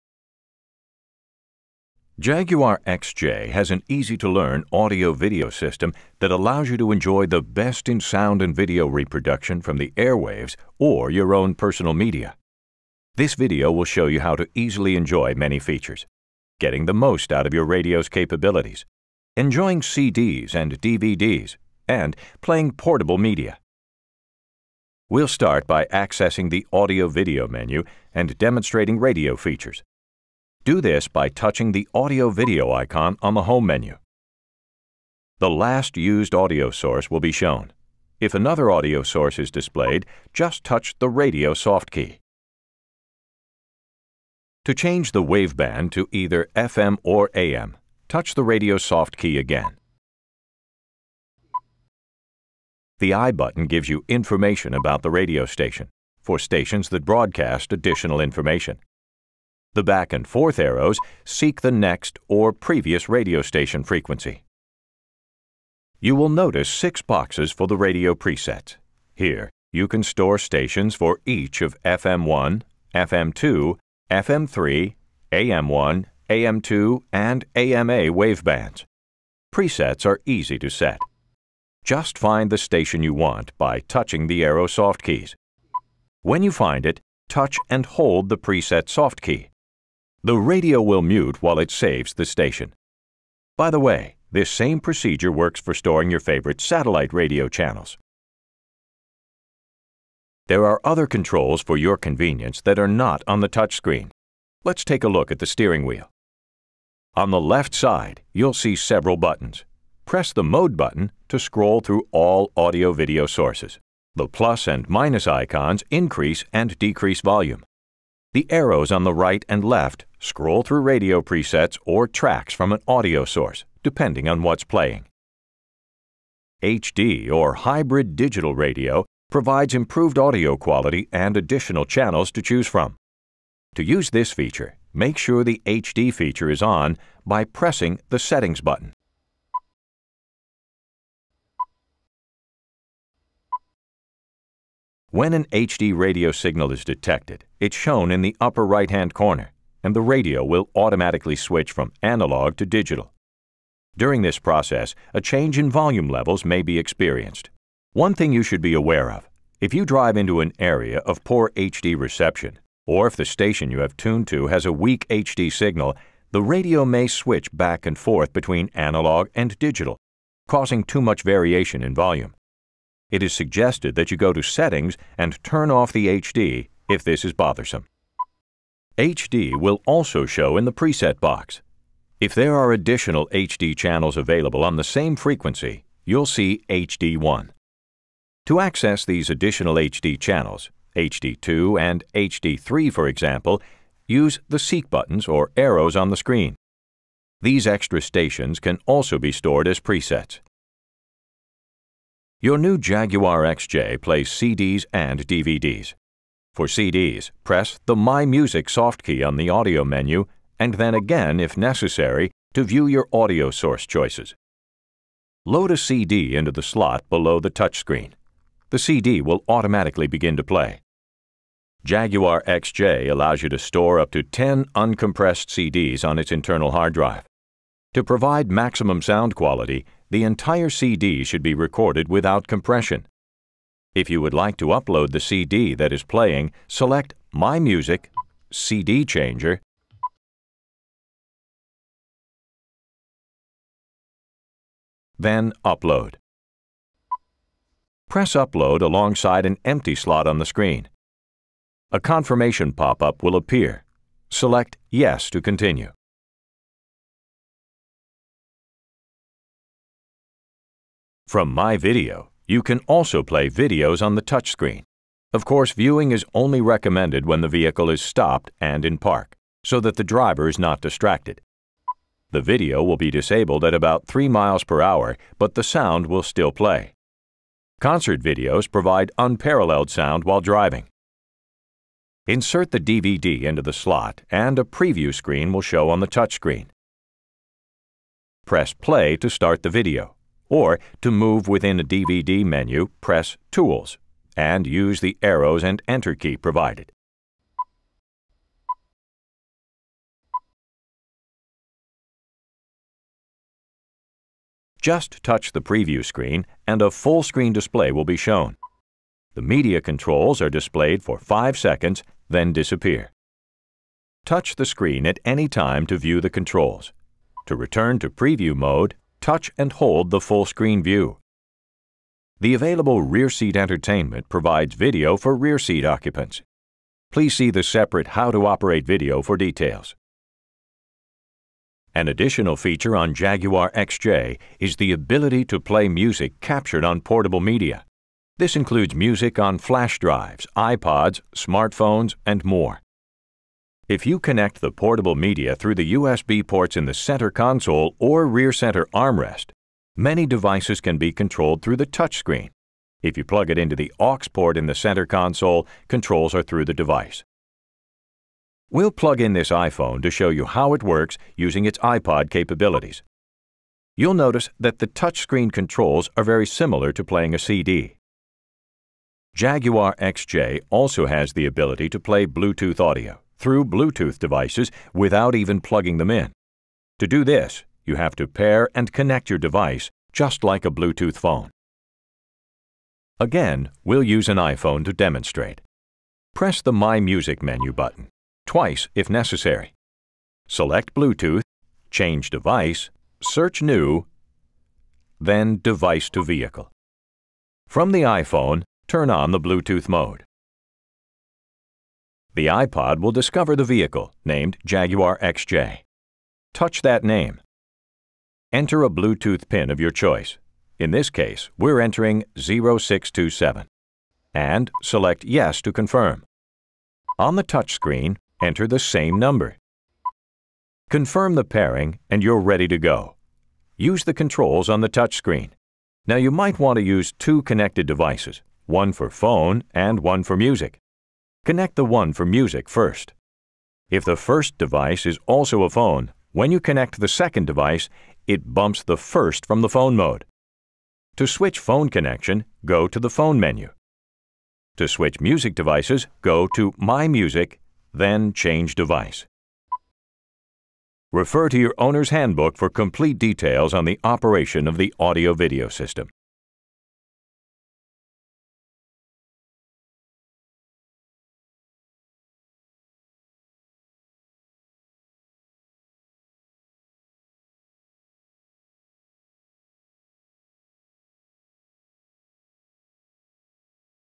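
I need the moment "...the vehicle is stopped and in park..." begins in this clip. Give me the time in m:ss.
4:27.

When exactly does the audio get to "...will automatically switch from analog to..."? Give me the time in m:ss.
2:30.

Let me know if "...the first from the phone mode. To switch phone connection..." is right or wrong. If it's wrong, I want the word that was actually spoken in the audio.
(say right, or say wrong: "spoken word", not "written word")
right.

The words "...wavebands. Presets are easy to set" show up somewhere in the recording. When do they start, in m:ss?
1:18.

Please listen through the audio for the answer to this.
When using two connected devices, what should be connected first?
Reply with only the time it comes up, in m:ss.
7:11.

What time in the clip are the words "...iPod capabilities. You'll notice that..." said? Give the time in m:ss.
6:01.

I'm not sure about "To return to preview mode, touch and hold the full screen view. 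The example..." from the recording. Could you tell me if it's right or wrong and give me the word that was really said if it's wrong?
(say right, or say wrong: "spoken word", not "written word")
wrong: "available", not "example".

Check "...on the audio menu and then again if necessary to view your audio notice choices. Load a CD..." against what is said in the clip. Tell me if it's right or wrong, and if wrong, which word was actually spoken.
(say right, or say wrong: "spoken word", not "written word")
wrong: "source", not "notice".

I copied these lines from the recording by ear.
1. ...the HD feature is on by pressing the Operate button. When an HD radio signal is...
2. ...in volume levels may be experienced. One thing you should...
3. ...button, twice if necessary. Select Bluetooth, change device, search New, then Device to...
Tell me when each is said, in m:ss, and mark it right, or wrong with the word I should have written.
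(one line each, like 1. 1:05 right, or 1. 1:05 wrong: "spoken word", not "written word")
1. 2:15 wrong: "Settings", not "Operate"
2. 2:35 right
3. 6:27 right.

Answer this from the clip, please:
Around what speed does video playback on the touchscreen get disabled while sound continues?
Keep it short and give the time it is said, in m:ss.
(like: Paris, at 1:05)
3 miles per hour, at 4:34.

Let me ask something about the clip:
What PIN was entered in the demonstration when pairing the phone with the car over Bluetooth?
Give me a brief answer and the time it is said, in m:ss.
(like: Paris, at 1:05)
0627, at 6:52.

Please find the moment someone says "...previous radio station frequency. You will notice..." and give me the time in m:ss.
1:02.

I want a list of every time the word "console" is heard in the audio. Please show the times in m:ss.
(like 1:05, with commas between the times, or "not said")
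5:47, 5:55.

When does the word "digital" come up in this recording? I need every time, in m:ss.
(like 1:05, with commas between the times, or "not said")
2:08, 2:32, 2:49.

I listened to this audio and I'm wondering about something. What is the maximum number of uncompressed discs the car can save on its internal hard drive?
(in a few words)
10.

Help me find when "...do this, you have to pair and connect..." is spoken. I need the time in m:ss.
6:17.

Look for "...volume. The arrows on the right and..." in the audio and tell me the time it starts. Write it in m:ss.
1:57.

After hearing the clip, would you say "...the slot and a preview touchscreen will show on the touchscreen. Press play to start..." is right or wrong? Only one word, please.
wrong.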